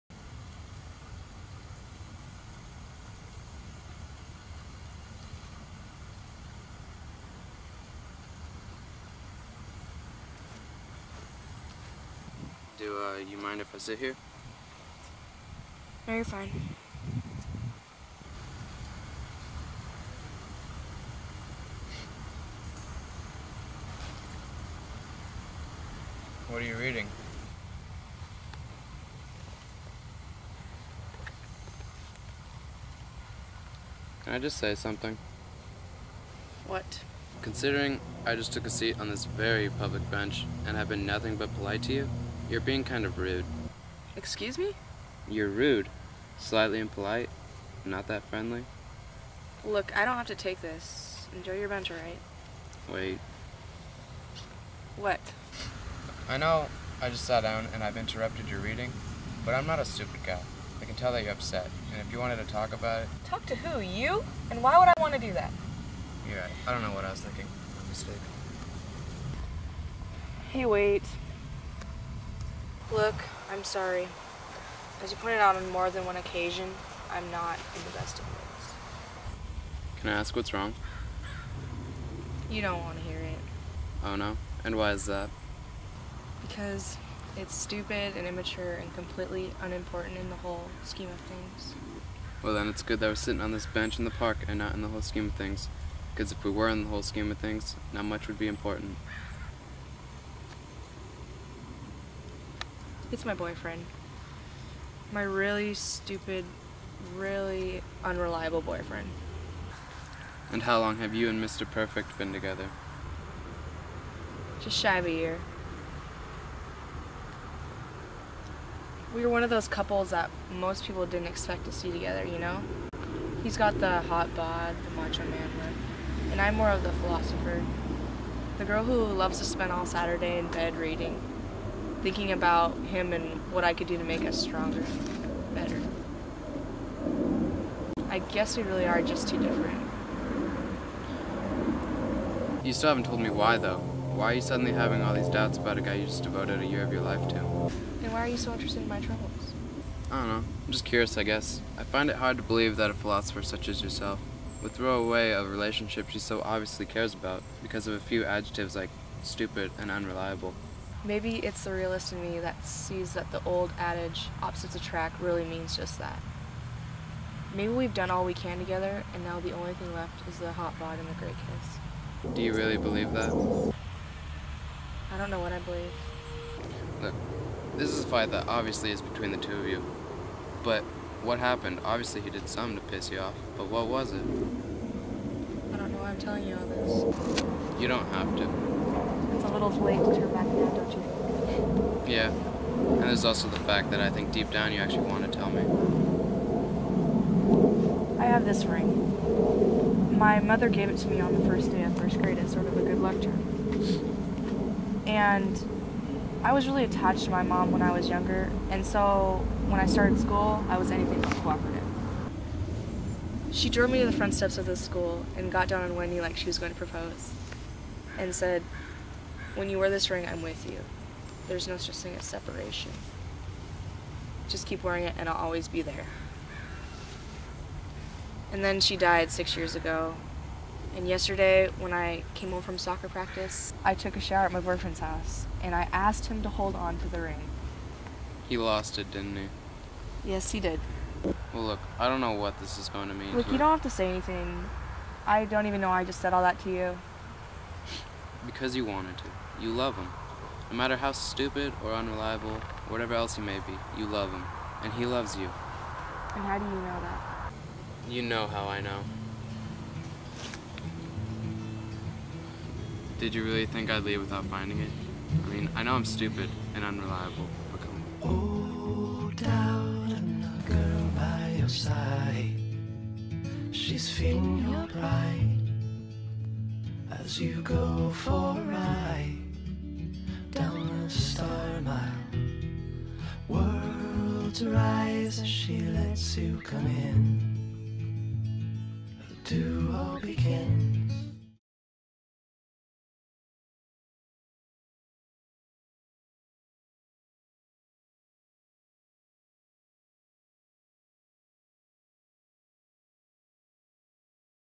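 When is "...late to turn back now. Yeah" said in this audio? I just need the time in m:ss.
3:09.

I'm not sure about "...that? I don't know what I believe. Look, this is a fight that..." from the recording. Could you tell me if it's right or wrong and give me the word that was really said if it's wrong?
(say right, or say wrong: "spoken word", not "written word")
right.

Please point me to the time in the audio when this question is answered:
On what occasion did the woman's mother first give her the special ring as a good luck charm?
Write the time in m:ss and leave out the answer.
3:21.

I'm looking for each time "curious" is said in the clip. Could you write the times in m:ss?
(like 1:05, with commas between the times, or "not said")
2:30.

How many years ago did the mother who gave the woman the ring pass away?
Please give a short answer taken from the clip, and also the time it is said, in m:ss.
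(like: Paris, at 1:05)
6, at 3:49.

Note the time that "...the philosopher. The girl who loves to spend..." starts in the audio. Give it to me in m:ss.
2:06.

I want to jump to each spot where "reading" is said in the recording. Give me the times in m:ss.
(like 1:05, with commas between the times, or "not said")
0:26, 0:58, 2:10.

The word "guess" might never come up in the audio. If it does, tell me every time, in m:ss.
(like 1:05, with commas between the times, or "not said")
2:18, 2:31.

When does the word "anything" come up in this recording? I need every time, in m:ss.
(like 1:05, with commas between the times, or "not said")
3:30, 4:04.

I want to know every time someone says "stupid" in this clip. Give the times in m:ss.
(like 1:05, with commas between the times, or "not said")
0:59, 1:27, 1:45, 2:39, 4:11, 4:26.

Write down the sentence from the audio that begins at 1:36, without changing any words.
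Because if we were in the whole scheme of things, not much would be important.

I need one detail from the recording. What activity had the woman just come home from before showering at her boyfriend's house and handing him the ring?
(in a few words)
Soccer practice.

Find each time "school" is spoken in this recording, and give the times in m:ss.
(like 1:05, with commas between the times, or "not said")
3:30, 3:34.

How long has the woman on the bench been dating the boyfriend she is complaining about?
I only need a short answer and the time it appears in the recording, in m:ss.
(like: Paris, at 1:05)
Just shy of a year, at 1:54.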